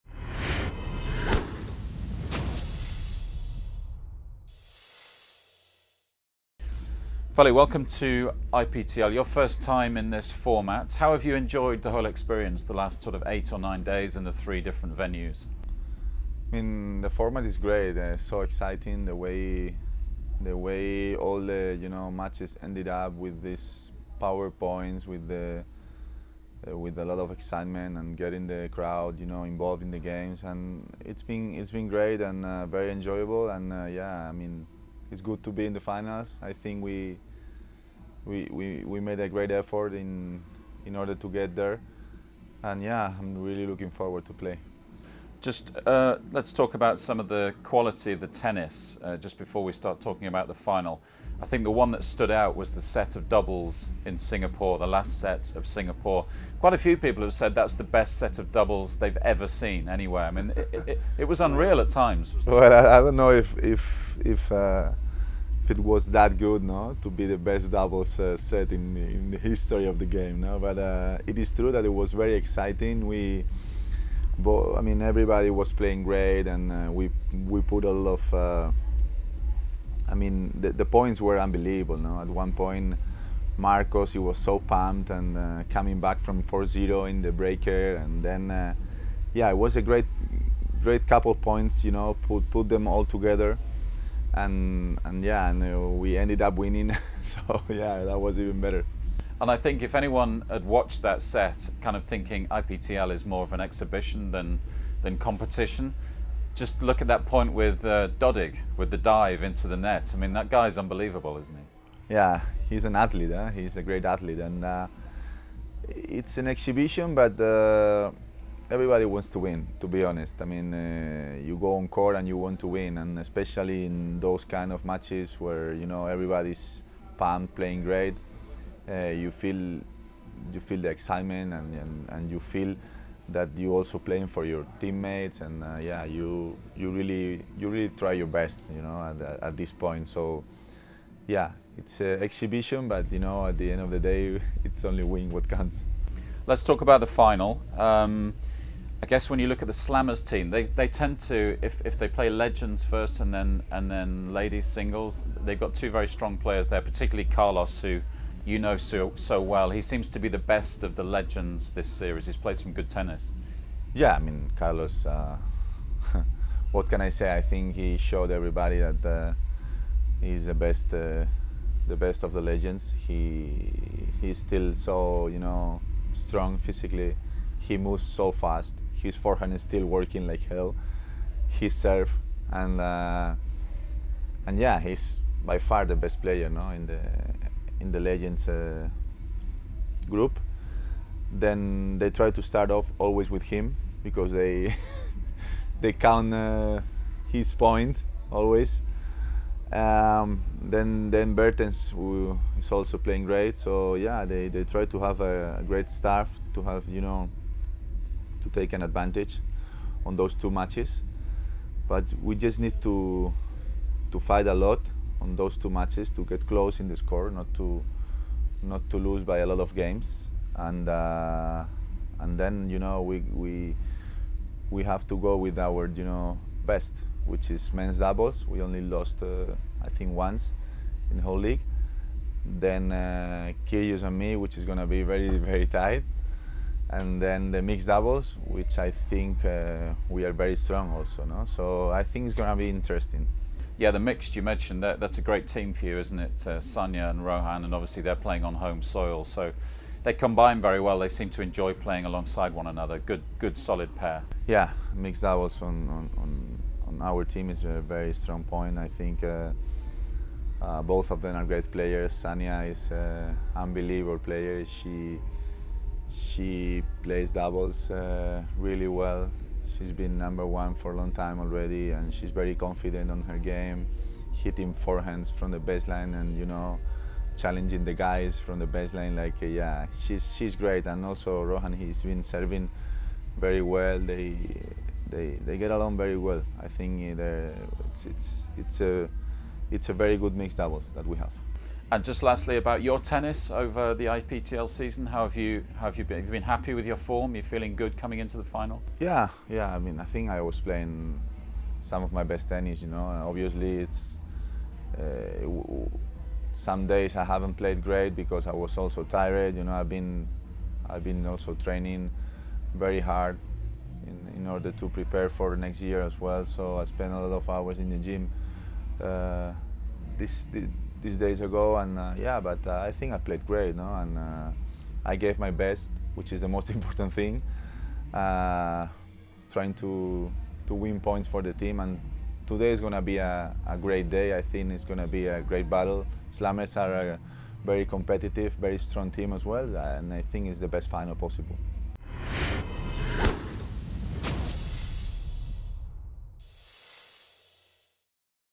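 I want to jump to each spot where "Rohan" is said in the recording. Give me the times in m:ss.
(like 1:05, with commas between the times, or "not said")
4:07, 4:41.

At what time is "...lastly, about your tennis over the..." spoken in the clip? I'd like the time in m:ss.
4:52.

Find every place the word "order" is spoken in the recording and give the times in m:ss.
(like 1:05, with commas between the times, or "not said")
0:40, 5:14.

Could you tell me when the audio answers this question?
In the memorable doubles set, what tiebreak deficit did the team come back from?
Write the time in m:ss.
1:26.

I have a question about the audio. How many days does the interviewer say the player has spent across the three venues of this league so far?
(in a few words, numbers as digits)
8 or 9.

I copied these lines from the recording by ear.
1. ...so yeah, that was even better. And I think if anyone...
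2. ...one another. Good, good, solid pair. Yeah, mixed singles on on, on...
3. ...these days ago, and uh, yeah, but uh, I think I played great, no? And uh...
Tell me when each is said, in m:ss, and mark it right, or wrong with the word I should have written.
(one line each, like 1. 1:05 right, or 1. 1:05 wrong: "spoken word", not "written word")
1. 1:37 right
2. 4:12 wrong: "doubles", not "singles"
3. 5:21 right.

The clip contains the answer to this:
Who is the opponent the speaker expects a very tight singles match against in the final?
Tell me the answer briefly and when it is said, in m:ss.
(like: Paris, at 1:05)
Kyrgios, at 3:53.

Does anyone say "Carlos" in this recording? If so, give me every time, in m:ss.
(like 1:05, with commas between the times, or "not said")
2:37, 2:44.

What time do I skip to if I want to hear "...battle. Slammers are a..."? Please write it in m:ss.
5:35.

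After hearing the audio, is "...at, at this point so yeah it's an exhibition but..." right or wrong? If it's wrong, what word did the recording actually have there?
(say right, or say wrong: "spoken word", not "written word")
right.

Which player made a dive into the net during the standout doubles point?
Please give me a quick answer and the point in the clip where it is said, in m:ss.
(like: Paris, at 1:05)
Dodig, at 1:48.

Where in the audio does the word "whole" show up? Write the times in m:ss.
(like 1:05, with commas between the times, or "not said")
0:11, 3:51.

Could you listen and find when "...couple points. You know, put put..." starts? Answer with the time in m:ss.
1:31.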